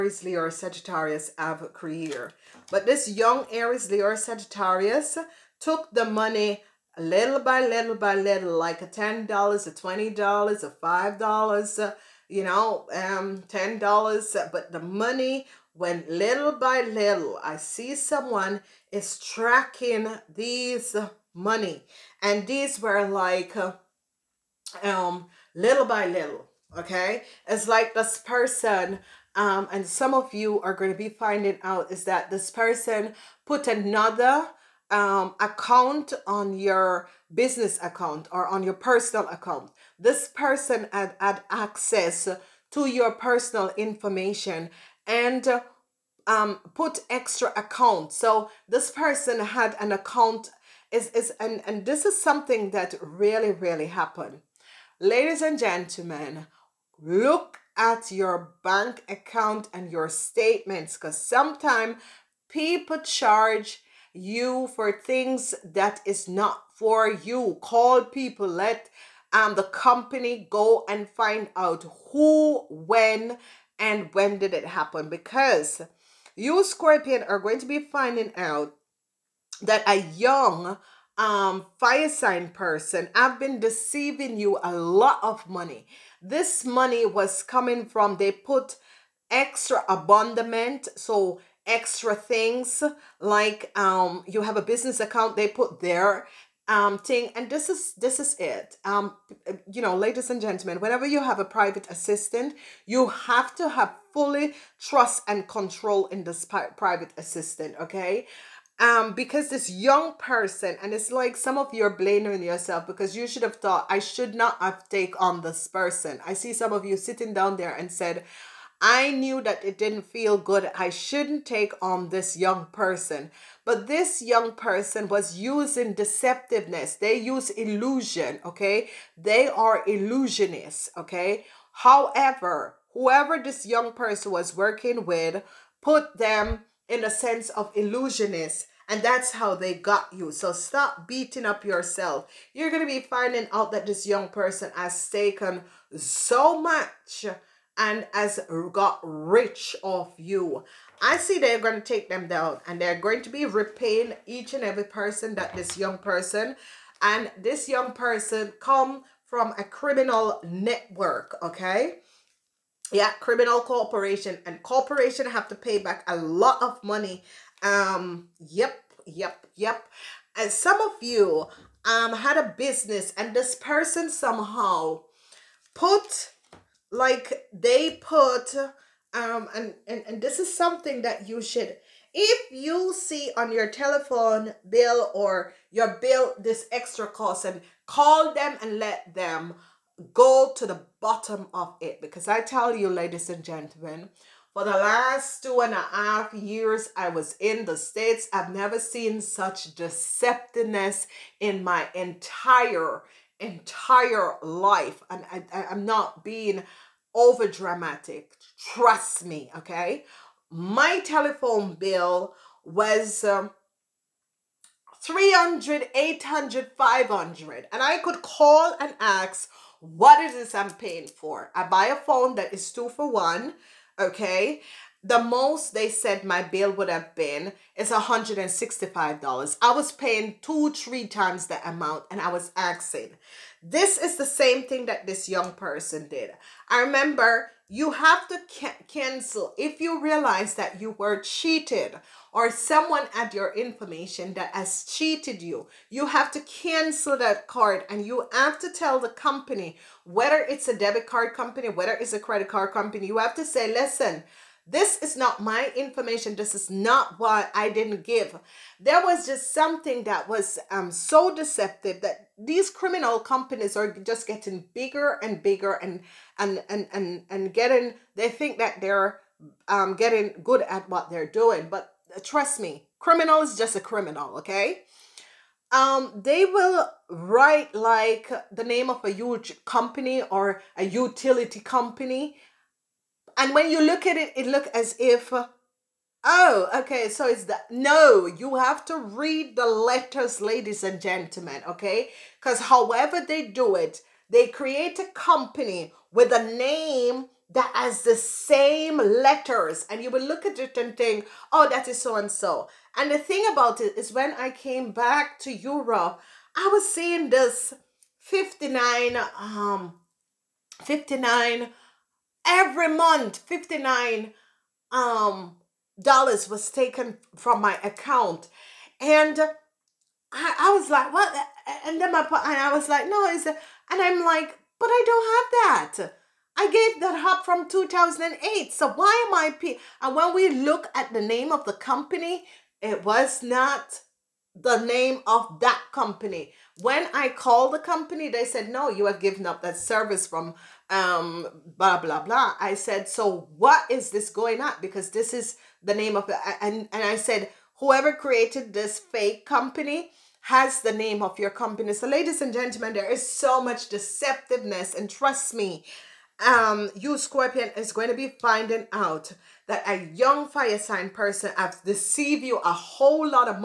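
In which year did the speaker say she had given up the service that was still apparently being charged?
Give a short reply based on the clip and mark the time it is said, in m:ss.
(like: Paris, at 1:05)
2008, at 5:27.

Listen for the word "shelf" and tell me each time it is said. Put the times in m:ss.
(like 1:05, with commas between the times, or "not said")
not said.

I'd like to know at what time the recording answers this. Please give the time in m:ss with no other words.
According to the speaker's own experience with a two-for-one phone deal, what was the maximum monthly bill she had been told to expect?
3:47.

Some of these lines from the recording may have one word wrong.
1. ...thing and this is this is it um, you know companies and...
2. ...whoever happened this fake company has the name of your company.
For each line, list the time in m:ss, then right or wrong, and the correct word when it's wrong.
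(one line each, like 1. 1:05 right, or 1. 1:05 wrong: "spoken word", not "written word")
1. 1:36 wrong: "ladies", not "companies"
2. 5:47 wrong: "created", not "happened".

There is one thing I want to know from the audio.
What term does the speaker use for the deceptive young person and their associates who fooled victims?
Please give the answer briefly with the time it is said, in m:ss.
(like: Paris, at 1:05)
illusionists, at 2:09.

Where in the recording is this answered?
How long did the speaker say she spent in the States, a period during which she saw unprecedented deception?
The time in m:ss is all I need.
3:15.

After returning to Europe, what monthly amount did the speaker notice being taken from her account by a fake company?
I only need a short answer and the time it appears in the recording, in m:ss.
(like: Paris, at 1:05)
59 dollars, at 5:13.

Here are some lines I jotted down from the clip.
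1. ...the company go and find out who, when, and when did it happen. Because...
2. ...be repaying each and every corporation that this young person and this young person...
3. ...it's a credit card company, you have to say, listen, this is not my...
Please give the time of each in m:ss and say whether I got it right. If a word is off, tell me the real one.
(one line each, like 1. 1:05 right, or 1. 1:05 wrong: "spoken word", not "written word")
1. 1:09 right
2. 2:33 wrong: "person", not "corporation"
3. 4:11 right.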